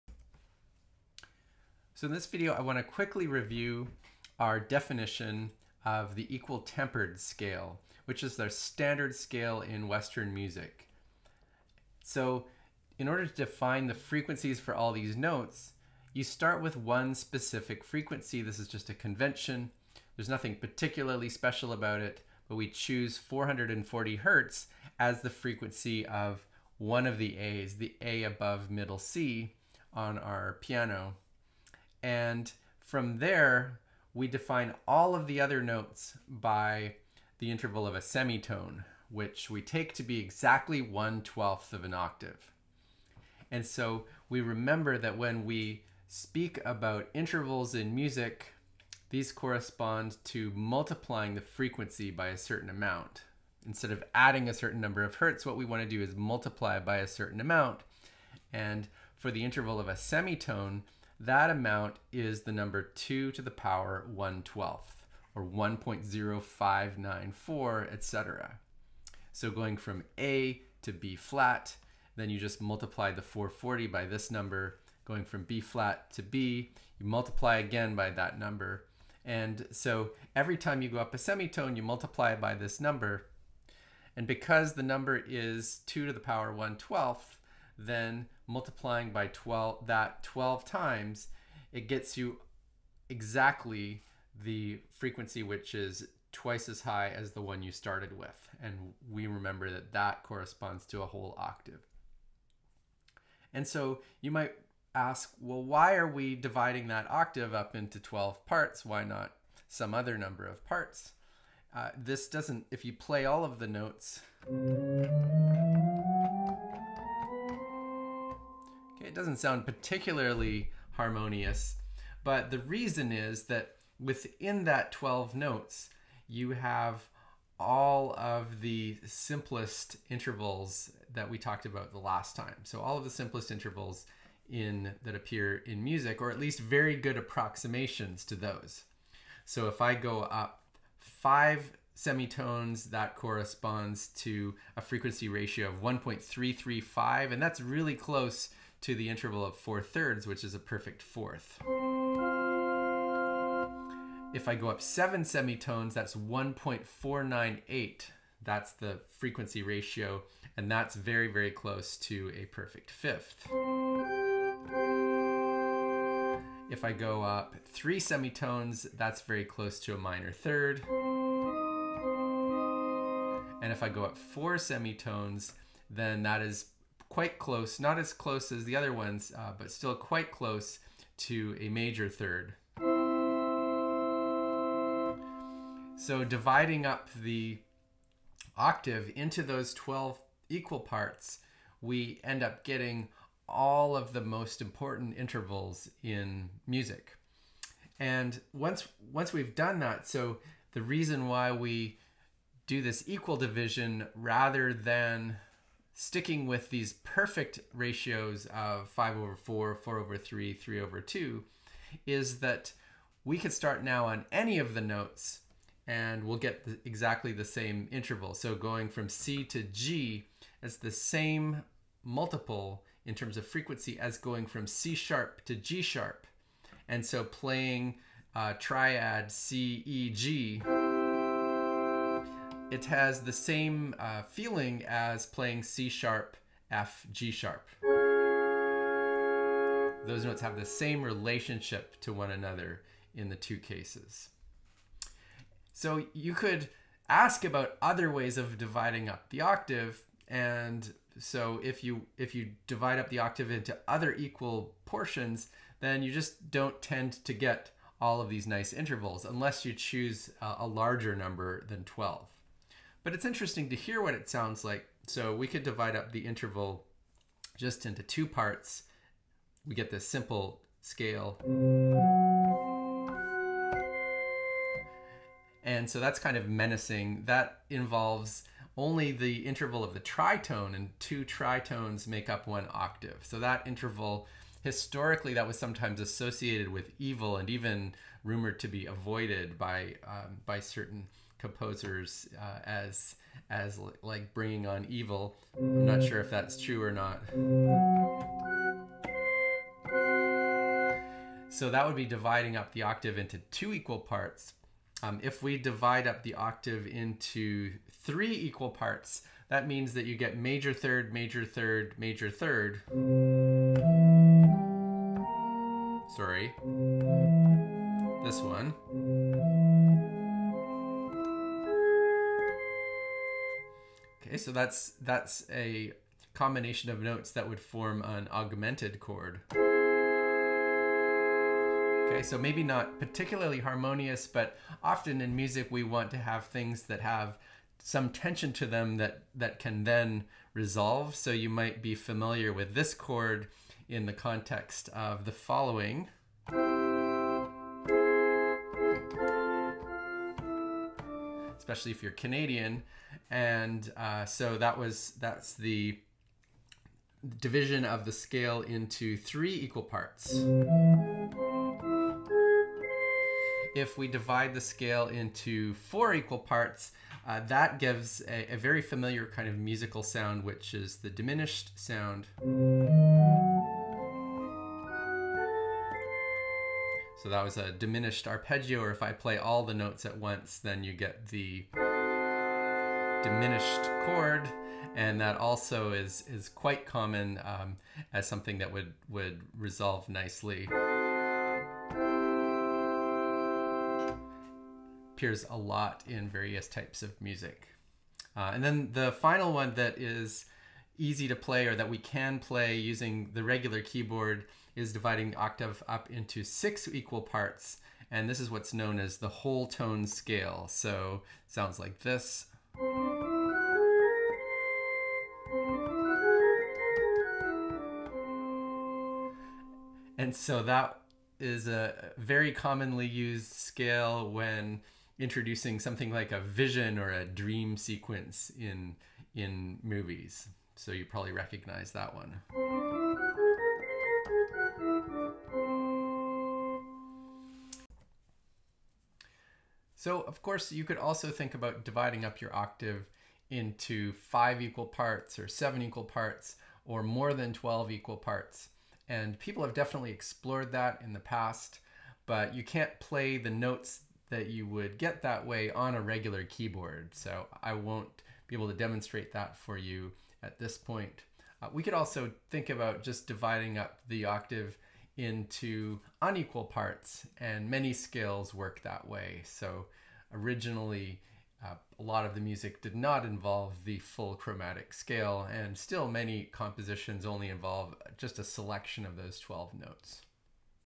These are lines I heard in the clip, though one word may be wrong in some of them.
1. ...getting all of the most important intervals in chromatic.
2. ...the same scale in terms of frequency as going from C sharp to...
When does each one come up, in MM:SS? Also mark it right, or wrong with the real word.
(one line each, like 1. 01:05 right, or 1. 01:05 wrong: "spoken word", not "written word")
1. 03:12 wrong: "music", not "chromatic"
2. 03:40 wrong: "multiple", not "scale".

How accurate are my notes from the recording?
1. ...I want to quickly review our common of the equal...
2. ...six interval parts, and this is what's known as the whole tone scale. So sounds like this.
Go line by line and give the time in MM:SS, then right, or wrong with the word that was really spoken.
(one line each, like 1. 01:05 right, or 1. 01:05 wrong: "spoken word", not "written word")
1. 00:02 wrong: "definition", not "common"
2. 06:46 wrong: "equal", not "interval".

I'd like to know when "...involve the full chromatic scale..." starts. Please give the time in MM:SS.
07:53.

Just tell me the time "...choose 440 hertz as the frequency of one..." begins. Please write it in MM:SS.
00:22.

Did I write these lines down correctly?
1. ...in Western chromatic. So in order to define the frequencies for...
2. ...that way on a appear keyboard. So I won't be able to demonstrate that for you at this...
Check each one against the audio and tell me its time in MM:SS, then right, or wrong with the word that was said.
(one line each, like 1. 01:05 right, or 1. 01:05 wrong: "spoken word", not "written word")
1. 00:09 wrong: "music", not "chromatic"
2. 07:35 wrong: "regular", not "appear".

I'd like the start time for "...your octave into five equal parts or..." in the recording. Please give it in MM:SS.
07:22.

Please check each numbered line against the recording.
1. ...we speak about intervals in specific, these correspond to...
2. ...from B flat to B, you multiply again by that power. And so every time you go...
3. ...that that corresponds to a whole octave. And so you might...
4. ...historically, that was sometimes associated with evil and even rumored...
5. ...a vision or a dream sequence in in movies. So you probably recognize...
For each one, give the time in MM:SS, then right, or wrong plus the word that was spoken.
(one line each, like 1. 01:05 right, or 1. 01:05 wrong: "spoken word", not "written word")
1. 00:45 wrong: "music", not "specific"
2. 01:15 wrong: "number", not "power"
3. 01:39 right
4. 04:44 right
5. 07:06 right.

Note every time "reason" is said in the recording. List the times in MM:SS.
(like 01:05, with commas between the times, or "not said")
02:02, 03:20.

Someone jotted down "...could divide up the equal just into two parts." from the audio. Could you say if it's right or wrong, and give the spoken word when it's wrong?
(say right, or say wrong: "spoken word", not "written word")
wrong: "interval", not "equal".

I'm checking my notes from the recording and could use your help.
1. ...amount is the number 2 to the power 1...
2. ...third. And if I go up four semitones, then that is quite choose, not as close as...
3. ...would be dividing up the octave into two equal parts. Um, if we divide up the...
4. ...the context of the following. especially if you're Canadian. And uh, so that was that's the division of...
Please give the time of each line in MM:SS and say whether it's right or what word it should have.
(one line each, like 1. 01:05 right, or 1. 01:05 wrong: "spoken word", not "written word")
1. 01:01 right
2. 02:50 wrong: "close", not "choose"
3. 05:01 right
4. 05:44 right.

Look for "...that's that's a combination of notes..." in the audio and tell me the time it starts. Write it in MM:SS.
05:24.